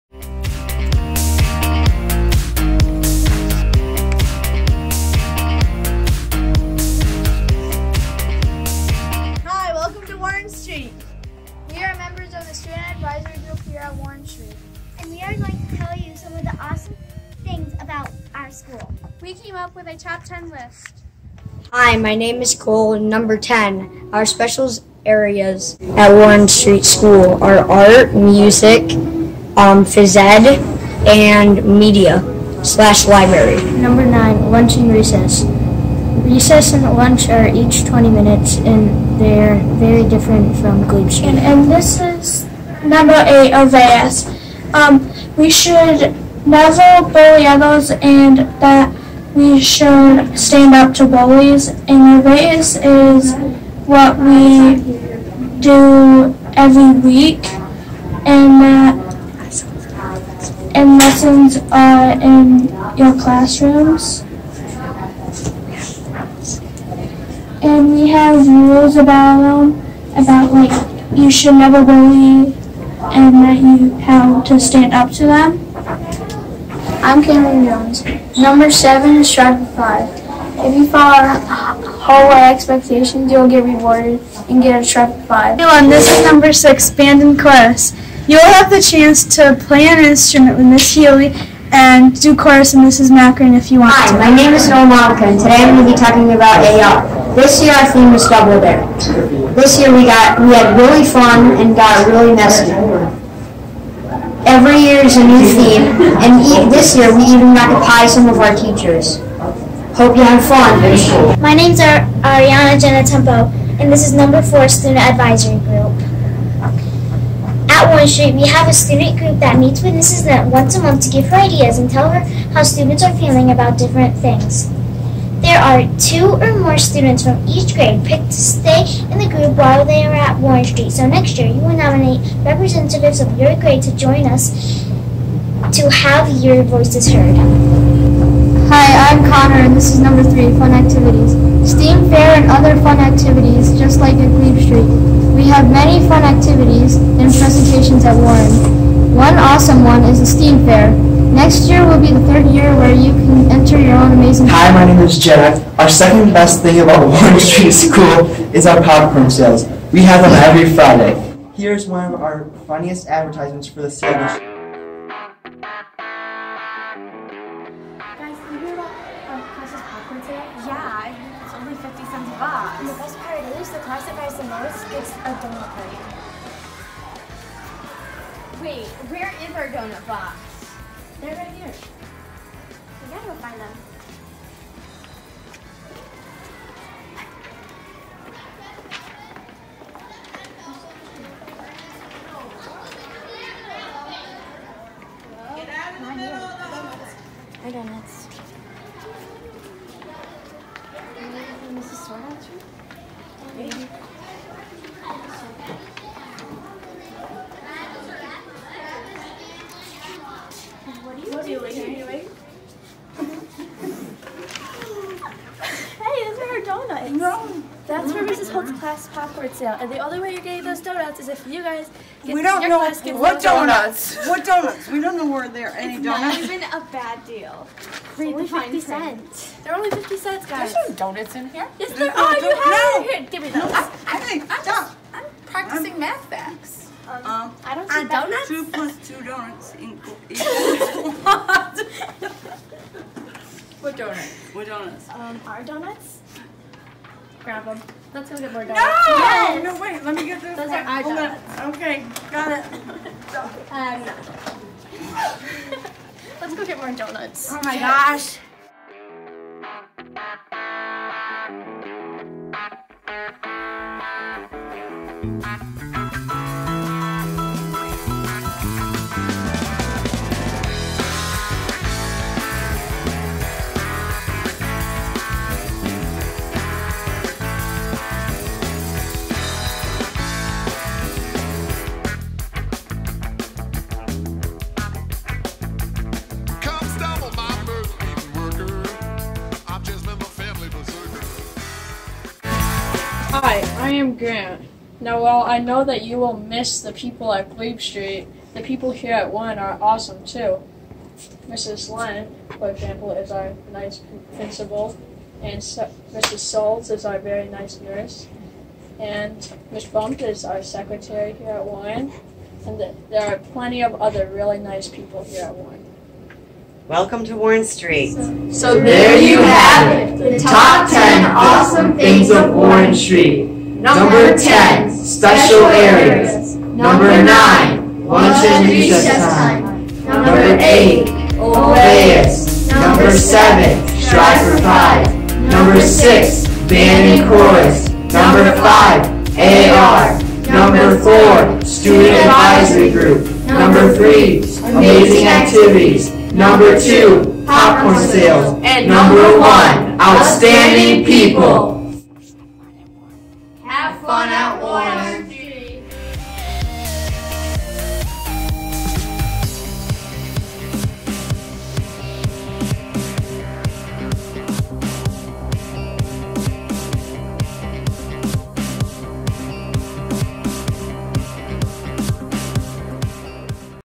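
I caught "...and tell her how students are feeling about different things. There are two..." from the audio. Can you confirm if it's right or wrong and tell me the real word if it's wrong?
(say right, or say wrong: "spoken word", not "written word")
right.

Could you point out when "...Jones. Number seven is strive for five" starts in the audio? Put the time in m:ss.
1:17.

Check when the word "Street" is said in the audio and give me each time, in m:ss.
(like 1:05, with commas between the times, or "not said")
0:26, 1:58, 2:10, 2:24, 2:37, 4:57, 5:17, 5:22.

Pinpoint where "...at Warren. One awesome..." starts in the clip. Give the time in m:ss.
2:28.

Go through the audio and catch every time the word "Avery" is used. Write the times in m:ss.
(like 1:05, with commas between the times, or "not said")
not said.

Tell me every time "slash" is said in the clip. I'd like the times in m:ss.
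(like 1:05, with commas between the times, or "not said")
0:32.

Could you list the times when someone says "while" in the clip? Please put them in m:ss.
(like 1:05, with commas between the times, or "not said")
2:09, 4:55.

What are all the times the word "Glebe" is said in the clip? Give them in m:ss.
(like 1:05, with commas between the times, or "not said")
0:40, 2:24, 4:57.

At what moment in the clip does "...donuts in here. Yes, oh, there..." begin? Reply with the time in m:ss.
3:50.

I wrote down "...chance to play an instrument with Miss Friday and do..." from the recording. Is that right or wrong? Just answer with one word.
wrong.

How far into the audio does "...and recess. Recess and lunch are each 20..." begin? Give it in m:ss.
0:34.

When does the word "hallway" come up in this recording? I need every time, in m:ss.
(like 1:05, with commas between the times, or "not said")
1:21.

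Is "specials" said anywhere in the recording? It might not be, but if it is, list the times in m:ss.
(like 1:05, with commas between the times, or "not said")
0:24, 5:24.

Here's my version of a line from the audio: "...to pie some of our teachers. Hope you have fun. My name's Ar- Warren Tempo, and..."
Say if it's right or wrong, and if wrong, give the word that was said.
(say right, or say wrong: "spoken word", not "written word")
wrong: "Ariana", not "Warren".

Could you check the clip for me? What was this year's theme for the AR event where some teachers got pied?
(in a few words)
Double dare.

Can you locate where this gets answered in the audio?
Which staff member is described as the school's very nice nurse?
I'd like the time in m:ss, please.
5:05.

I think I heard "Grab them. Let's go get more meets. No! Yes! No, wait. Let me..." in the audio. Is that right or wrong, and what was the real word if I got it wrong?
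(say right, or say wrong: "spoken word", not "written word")
wrong: "donuts", not "meets".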